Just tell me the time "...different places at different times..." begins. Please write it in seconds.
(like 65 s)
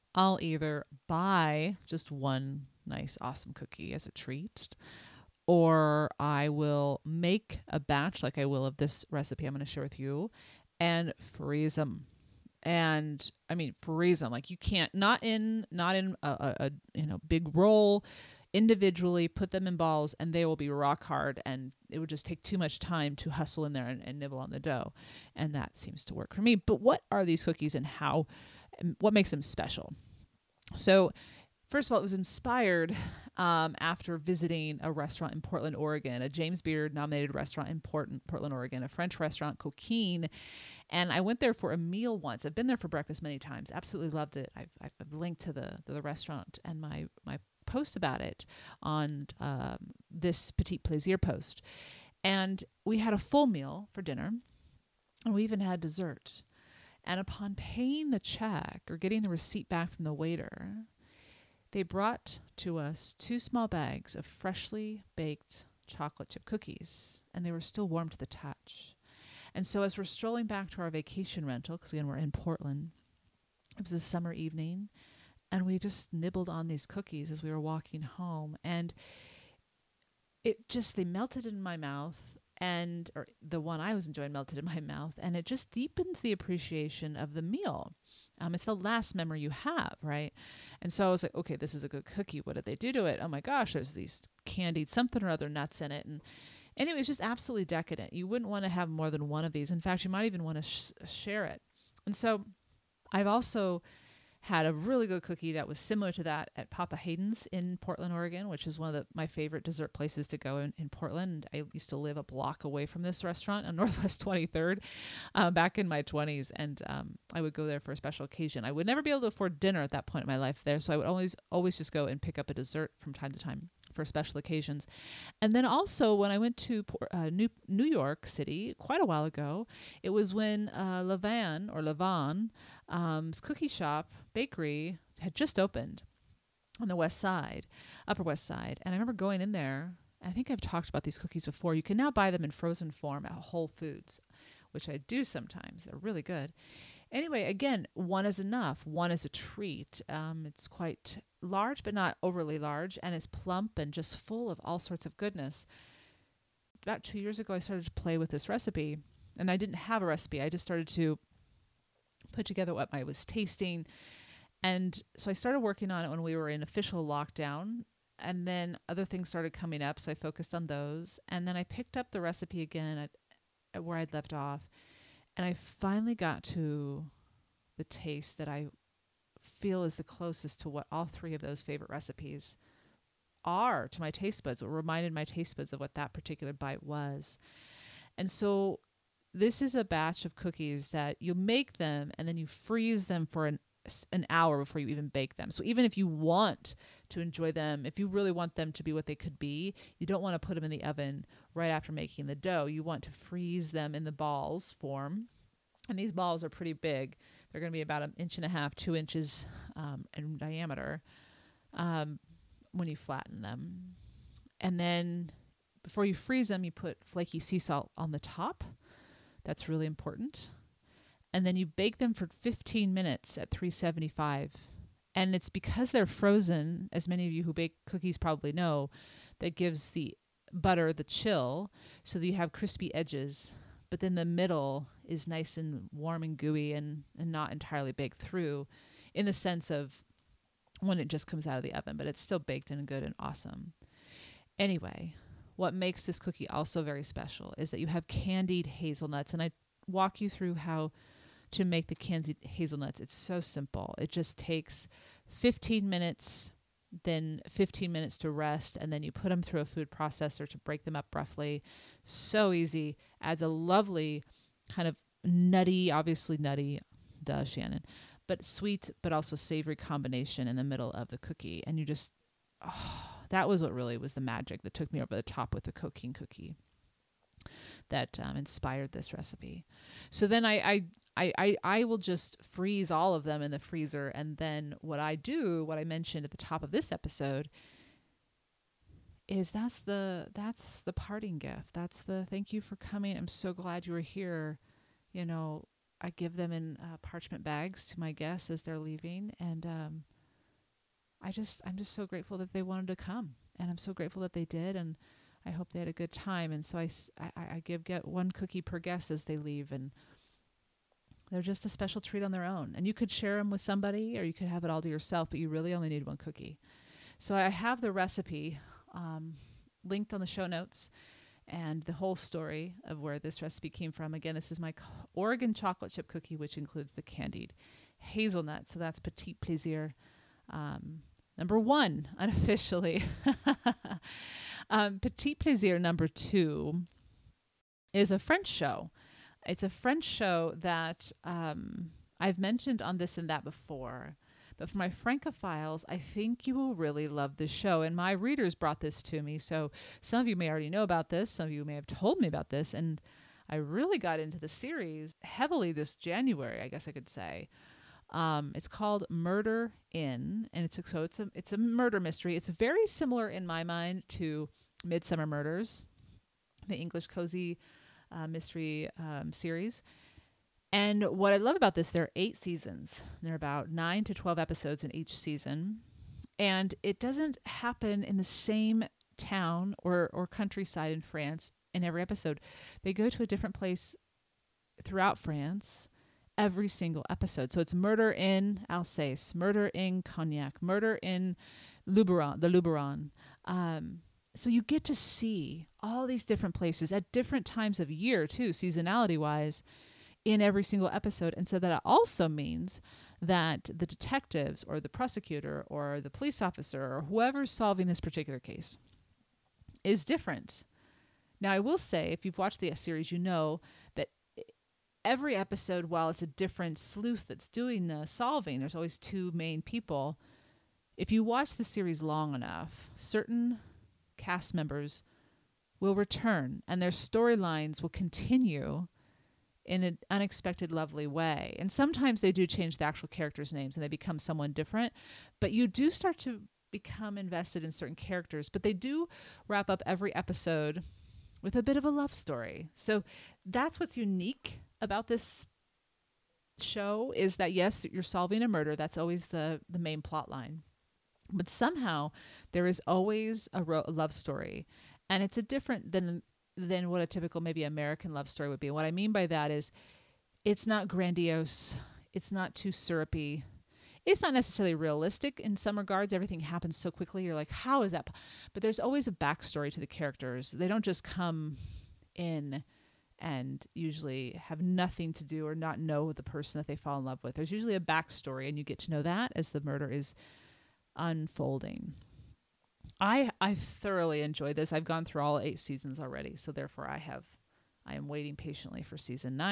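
396 s.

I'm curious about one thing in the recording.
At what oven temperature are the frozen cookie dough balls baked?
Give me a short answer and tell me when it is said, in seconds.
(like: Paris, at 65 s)
375, at 223 s.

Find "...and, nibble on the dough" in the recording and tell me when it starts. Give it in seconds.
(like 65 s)
24 s.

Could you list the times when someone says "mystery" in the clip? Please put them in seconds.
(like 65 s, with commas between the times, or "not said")
362 s, 368 s.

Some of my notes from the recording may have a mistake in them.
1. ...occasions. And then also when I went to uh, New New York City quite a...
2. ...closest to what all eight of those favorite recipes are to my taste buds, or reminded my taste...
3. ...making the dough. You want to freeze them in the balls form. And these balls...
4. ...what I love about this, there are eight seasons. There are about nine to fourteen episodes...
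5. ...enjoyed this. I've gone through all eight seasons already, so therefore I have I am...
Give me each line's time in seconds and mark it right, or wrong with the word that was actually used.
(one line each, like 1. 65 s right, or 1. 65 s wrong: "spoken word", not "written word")
1. 124 s right
2. 180 s wrong: "three", not "eight"
3. 201 s right
4. 371 s wrong: "twelve", not "fourteen"
5. 484 s right.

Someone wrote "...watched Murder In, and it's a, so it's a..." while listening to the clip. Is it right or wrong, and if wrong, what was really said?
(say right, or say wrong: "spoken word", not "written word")
wrong: "called", not "watched".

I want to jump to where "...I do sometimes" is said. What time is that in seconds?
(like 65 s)
144 s.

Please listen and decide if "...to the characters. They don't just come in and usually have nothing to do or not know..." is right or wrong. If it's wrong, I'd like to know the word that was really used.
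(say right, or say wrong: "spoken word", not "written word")
right.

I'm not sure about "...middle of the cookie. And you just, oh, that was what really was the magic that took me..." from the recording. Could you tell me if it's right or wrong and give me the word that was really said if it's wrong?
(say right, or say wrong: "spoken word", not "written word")
right.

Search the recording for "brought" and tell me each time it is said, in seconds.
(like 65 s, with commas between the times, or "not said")
61 s, 348 s.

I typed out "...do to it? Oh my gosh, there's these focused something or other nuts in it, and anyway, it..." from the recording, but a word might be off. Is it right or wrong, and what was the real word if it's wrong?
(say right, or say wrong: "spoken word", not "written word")
wrong: "candied", not "focused".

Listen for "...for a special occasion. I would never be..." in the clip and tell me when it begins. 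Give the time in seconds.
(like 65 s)
117 s.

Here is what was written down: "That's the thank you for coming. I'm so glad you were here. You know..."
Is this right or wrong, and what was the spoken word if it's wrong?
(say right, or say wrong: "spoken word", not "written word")
right.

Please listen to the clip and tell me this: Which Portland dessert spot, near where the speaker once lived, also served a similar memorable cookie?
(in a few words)
Papa Haydn's.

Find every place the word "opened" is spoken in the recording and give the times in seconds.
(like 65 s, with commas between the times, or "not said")
135 s.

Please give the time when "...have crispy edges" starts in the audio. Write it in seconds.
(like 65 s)
232 s.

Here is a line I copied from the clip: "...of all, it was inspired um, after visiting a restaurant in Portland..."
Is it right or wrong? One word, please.
right.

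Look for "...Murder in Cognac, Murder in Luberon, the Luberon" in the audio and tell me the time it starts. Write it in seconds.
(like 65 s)
389 s.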